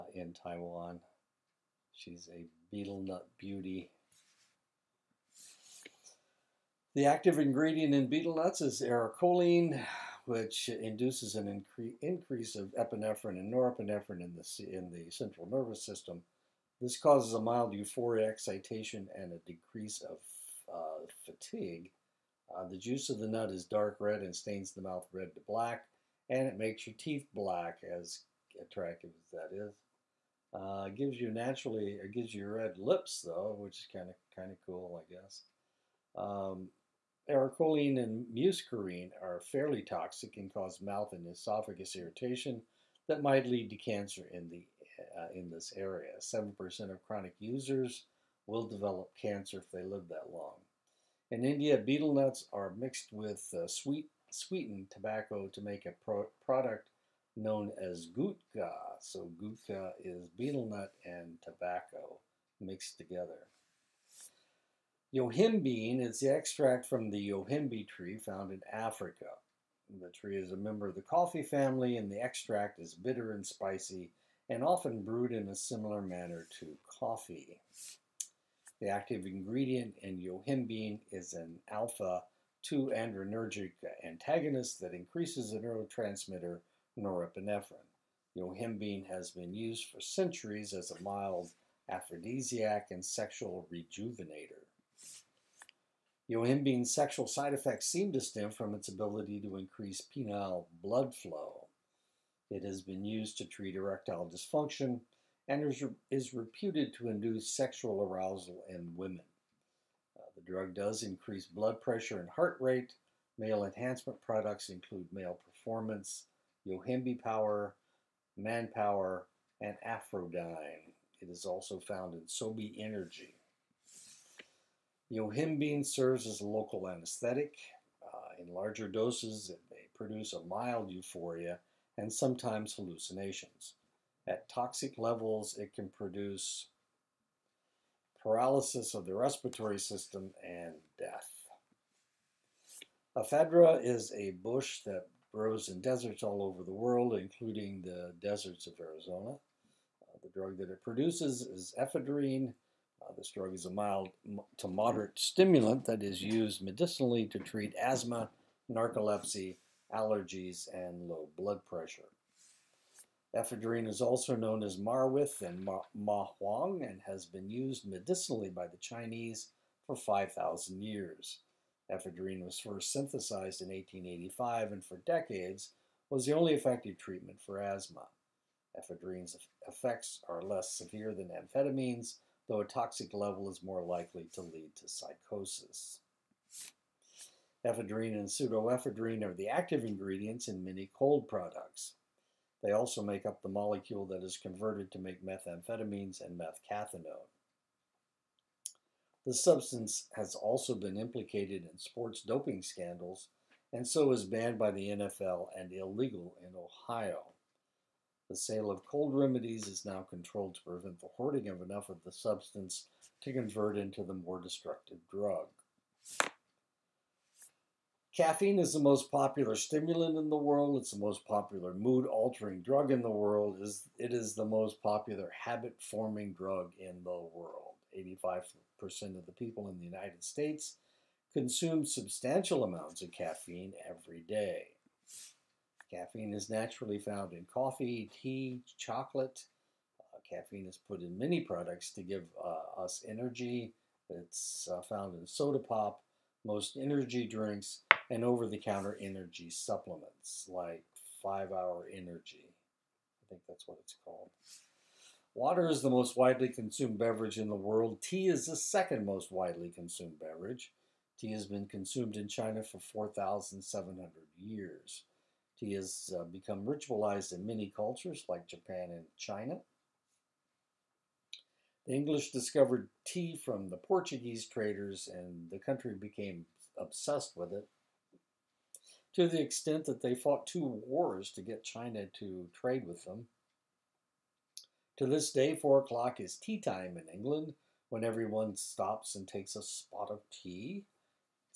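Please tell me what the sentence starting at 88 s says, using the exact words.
Yohimbine has been used for centuries as a mild aphrodisiac and sexual rejuvenator.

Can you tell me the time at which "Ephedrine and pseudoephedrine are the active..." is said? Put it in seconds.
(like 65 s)
187 s.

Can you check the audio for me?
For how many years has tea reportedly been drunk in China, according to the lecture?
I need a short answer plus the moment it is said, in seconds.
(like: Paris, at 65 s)
4,700 years, at 262 s.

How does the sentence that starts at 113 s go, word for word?
Male enhancement products include male performance, Yohimbe power, manpower, and Aphrodyne.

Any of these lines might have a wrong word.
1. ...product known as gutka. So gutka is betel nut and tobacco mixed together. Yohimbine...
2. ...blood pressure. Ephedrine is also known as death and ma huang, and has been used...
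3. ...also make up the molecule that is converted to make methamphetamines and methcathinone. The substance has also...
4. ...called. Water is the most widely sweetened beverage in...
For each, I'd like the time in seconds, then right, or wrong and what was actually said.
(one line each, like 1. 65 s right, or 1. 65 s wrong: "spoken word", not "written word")
1. 56 s right
2. 161 s wrong: "marwith", not "death"
3. 192 s right
4. 254 s wrong: "consumed", not "sweetened".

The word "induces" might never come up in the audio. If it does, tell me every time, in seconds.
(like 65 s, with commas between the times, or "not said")
10 s, 107 s.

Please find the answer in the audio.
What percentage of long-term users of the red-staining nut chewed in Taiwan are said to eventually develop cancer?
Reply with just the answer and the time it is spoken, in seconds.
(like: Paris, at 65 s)
7%, at 46 s.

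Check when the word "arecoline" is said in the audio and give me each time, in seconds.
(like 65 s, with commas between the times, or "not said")
8 s, 37 s.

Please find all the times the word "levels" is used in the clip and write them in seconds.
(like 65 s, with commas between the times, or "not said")
134 s, 183 s.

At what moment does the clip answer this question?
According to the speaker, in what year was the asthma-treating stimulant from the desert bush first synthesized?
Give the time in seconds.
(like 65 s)
173 s.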